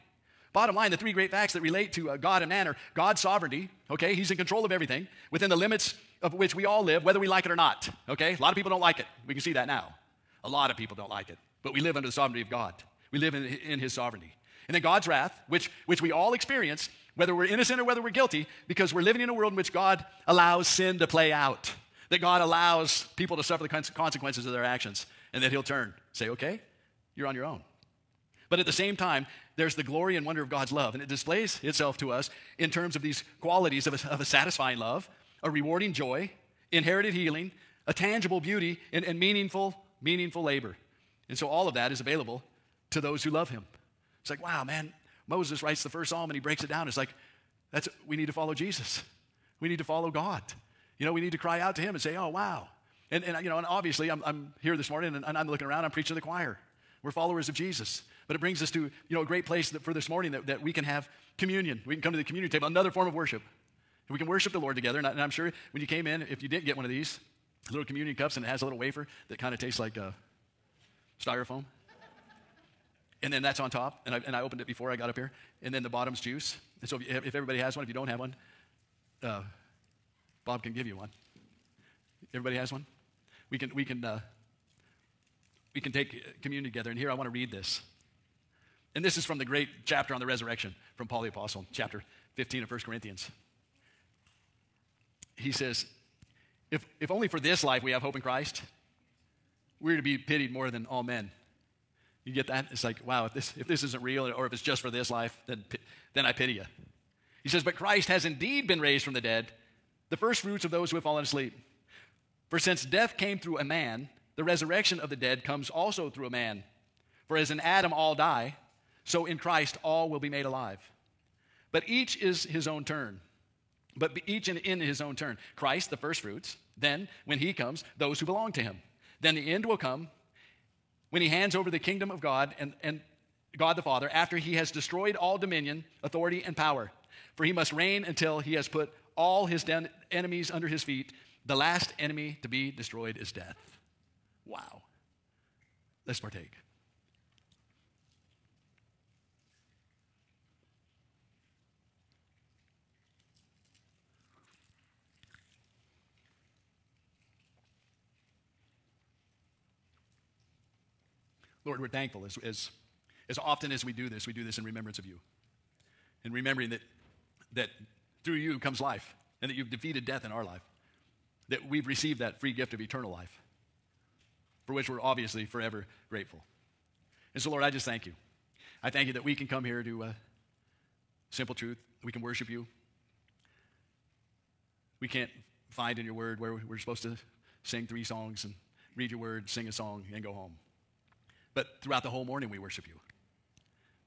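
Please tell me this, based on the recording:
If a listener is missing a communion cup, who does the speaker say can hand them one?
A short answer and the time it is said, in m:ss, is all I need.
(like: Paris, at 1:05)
Bob, at 1:20.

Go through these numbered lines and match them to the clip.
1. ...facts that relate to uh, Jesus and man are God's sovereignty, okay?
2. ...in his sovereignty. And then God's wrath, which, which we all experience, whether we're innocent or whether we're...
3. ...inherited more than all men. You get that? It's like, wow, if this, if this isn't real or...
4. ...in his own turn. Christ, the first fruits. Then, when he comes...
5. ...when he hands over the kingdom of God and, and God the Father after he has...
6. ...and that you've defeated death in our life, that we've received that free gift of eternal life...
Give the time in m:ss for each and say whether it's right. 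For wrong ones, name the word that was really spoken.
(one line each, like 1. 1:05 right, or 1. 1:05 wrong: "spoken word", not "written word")
1. 0:01 wrong: "God", not "Jesus"
2. 0:13 right
3. 1:40 wrong: "pitied", not "inherited"
4. 2:04 right
5. 2:11 right
6. 2:49 right.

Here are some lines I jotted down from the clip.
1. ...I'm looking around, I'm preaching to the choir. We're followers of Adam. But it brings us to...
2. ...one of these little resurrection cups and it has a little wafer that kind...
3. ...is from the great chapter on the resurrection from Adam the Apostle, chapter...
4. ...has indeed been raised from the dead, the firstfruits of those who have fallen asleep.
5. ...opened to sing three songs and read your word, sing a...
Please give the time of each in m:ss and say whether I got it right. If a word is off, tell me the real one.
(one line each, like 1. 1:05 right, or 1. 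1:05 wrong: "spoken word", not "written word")
1. 0:55 wrong: "Jesus", not "Adam"
2. 1:06 wrong: "communion", not "resurrection"
3. 1:29 wrong: "Paul", not "Adam"
4. 1:48 right
5. 3:06 wrong: "supposed", not "opened".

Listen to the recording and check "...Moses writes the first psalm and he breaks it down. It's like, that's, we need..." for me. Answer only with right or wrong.
right.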